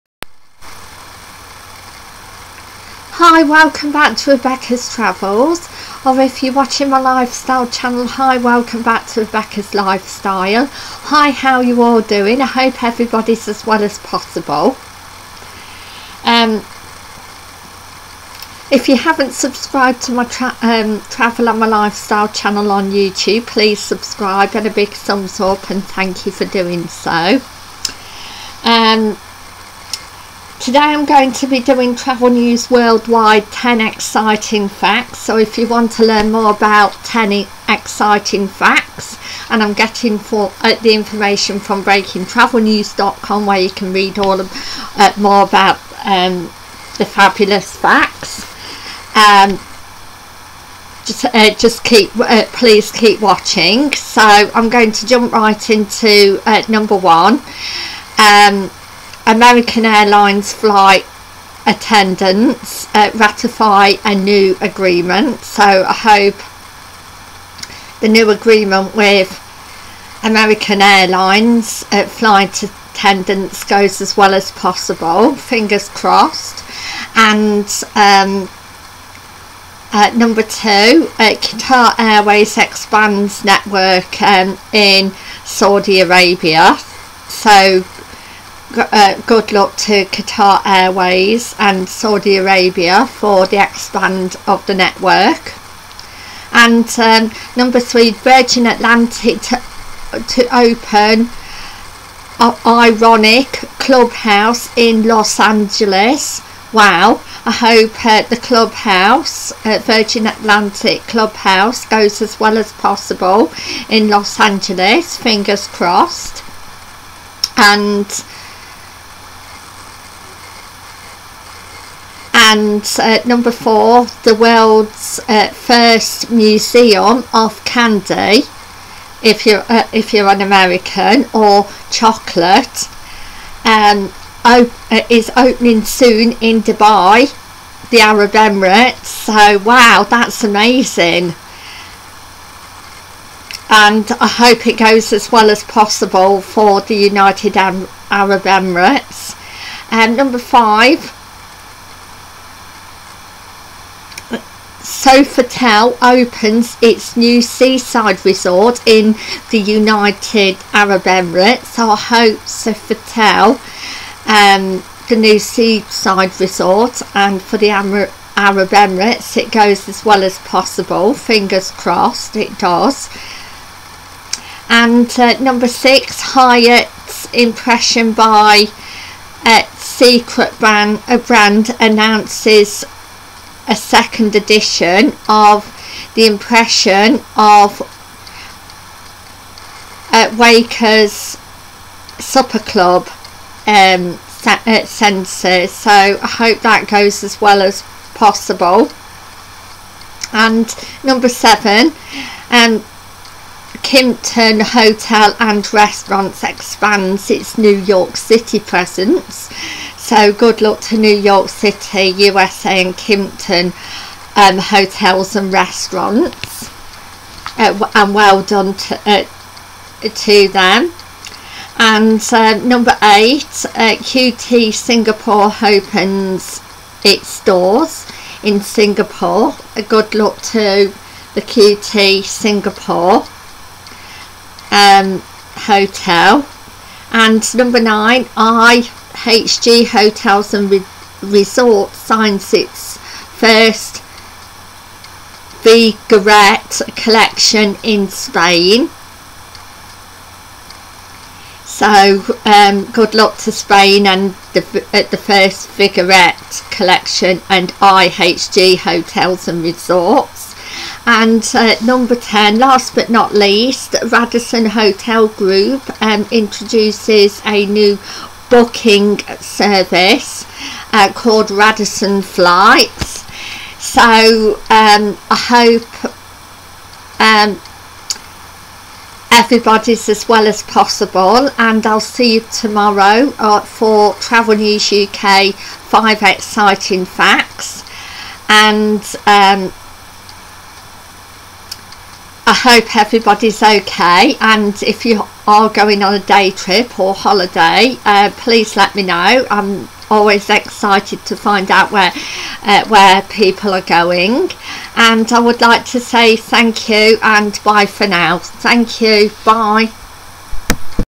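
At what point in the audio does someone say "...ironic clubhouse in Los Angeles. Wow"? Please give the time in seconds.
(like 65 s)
102 s.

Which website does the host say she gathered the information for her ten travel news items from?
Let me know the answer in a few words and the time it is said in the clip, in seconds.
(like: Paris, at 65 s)
breakingtravelnews.com, at 41 s.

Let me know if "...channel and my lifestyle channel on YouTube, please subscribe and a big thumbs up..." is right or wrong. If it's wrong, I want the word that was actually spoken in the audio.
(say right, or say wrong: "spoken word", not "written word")
wrong: "travel", not "channel".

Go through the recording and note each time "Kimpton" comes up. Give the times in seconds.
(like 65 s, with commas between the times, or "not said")
203 s, 212 s.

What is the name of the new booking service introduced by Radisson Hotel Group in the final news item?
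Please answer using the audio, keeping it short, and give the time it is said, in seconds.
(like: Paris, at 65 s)
Radisson Flights, at 271 s.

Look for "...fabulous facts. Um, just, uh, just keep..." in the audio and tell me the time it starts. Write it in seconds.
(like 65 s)
47 s.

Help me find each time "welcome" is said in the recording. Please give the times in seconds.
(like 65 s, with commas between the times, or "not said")
3 s, 8 s.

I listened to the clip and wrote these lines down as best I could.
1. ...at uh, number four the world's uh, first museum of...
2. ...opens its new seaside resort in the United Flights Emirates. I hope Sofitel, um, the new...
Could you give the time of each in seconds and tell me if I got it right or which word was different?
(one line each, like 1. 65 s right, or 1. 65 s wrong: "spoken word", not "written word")
1. 122 s right
2. 156 s wrong: "Arab", not "Flights".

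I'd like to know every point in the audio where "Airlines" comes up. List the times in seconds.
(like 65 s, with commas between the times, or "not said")
59 s, 70 s.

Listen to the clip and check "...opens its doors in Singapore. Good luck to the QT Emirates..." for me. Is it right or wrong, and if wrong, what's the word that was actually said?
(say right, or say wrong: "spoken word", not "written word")
wrong: "Singapore", not "Emirates".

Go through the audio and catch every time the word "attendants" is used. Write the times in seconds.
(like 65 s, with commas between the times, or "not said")
61 s, 72 s.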